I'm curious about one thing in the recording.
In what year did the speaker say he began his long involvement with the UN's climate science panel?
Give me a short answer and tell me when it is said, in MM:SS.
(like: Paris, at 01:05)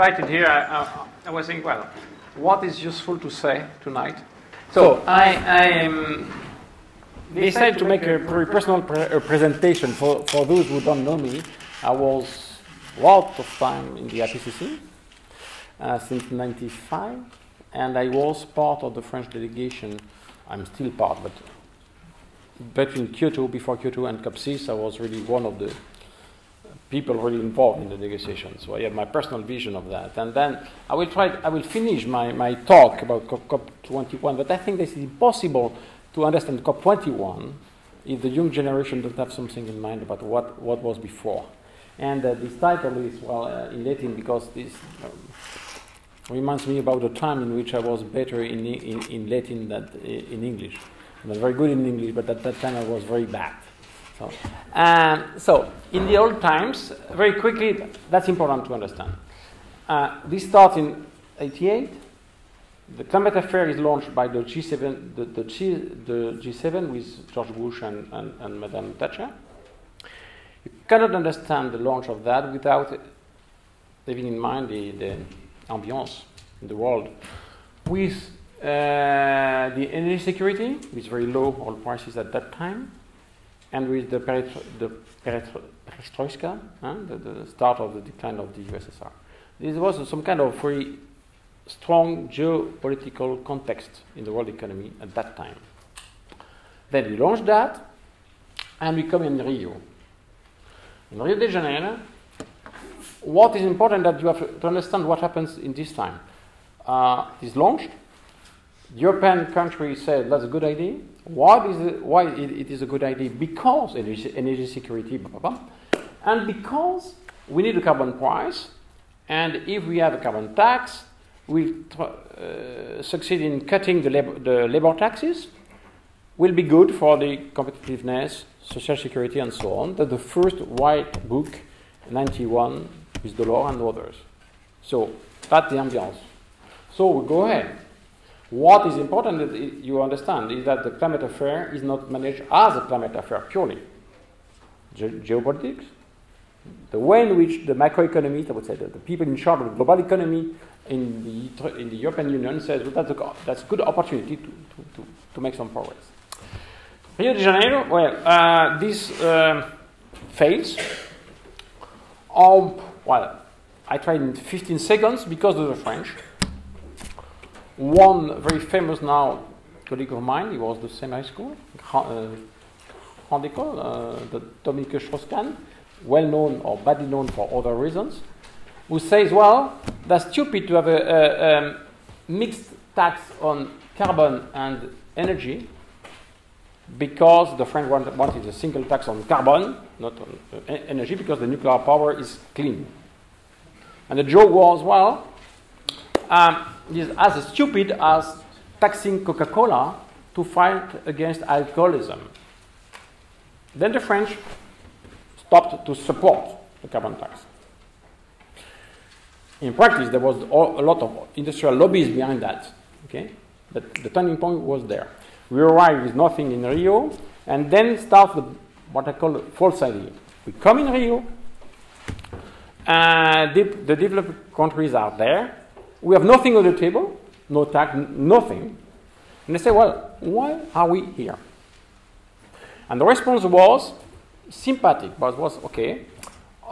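1995, at 00:16.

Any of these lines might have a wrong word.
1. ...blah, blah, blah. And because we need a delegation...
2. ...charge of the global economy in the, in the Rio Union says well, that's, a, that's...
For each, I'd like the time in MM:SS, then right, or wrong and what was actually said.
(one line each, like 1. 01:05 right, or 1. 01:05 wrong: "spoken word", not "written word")
1. 01:55 wrong: "carbon", not "delegation"
2. 02:29 wrong: "European", not "Rio".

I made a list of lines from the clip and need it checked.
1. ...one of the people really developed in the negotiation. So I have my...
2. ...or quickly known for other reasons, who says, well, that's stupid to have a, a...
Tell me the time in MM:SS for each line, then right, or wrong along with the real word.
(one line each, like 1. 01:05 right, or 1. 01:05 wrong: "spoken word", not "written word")
1. 00:25 wrong: "involved", not "developed"
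2. 02:56 wrong: "badly", not "quickly".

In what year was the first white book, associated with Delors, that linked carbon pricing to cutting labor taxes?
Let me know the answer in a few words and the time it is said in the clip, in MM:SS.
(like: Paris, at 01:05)
1991, at 02:12.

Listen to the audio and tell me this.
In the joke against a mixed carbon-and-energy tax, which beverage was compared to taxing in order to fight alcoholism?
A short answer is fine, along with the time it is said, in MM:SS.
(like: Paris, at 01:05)
Coca Cola, at 03:19.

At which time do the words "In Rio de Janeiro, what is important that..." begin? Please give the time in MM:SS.
01:41.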